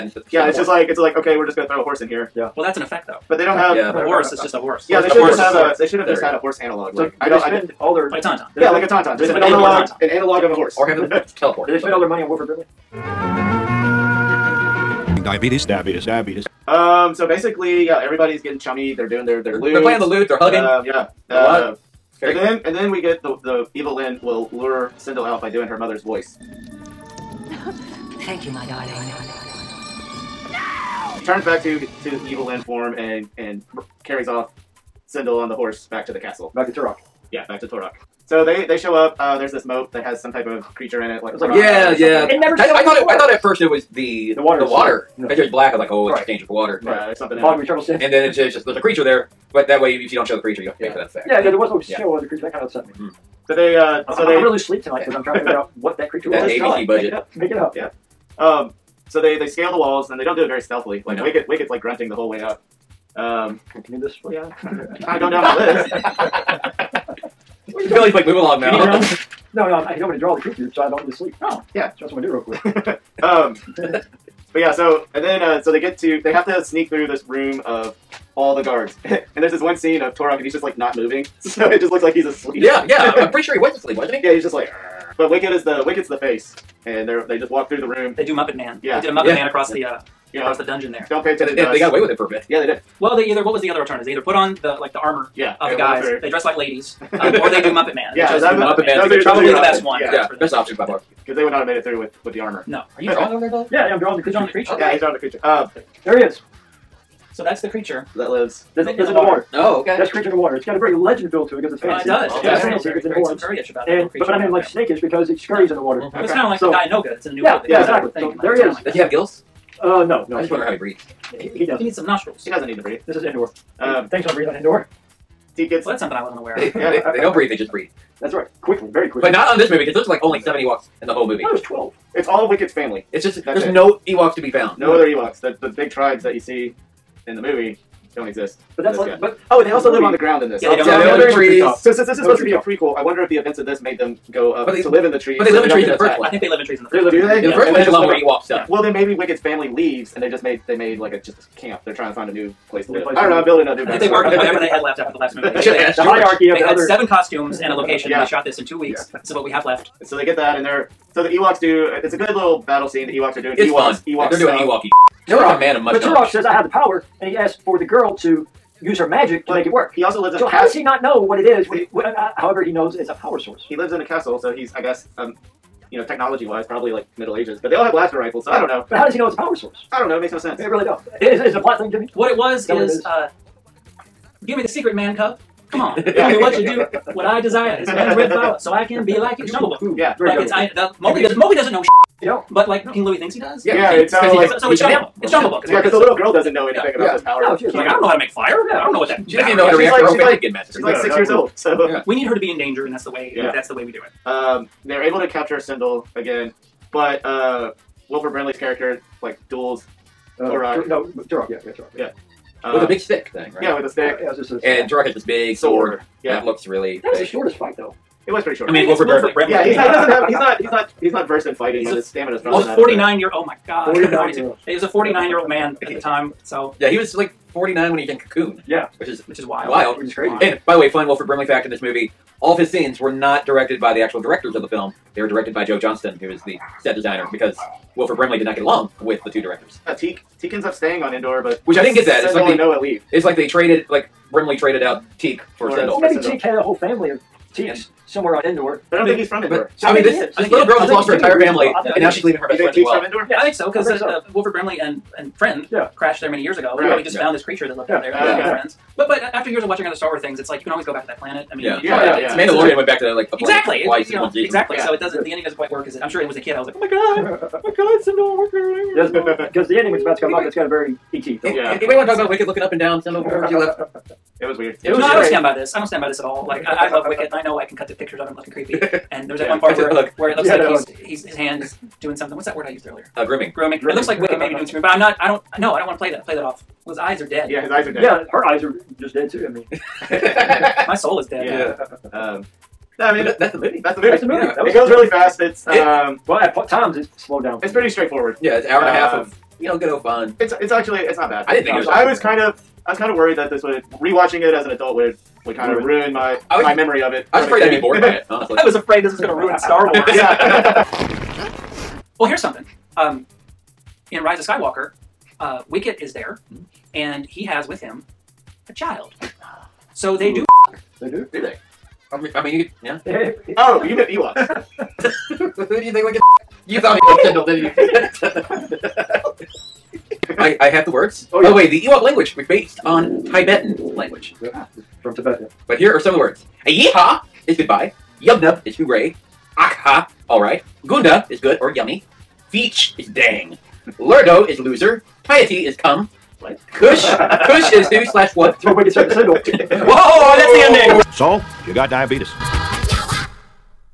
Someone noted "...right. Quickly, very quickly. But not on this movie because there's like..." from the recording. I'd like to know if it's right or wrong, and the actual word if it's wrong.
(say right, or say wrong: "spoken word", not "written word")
right.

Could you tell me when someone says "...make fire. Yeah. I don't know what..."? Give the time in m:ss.
3:18.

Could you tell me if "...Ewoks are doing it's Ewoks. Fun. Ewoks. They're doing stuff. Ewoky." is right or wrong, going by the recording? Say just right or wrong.
right.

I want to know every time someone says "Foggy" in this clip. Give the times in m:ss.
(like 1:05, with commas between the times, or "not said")
0:47.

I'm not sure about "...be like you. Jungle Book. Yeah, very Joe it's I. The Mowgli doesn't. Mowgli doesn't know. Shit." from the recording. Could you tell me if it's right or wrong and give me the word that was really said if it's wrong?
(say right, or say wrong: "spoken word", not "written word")
wrong: "Like", not "Joe".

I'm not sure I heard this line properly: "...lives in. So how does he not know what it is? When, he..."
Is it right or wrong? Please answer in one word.
right.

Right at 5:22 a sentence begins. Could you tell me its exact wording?
I mean, I mean you could.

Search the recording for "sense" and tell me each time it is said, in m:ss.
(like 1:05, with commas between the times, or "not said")
3:00.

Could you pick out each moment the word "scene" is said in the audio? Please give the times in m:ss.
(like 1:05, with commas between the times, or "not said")
1:19, 2:42, 3:52.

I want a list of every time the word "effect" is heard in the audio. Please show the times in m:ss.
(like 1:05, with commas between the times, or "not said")
0:02, 0:51.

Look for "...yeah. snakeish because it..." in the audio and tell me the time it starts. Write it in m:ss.
1:54.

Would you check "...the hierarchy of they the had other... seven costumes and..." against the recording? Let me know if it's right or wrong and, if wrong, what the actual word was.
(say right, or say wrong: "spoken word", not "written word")
right.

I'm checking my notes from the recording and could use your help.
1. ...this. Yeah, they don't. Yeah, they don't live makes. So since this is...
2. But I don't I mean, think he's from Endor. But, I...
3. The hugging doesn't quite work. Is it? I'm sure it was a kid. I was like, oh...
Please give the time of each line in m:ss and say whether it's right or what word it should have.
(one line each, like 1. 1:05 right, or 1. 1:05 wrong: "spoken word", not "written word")
1. 2:20 wrong: "trees", not "makes"
2. 4:08 right
3. 4:25 wrong: "ending", not "hugging".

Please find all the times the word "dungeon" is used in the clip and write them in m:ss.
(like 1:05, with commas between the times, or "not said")
1:30.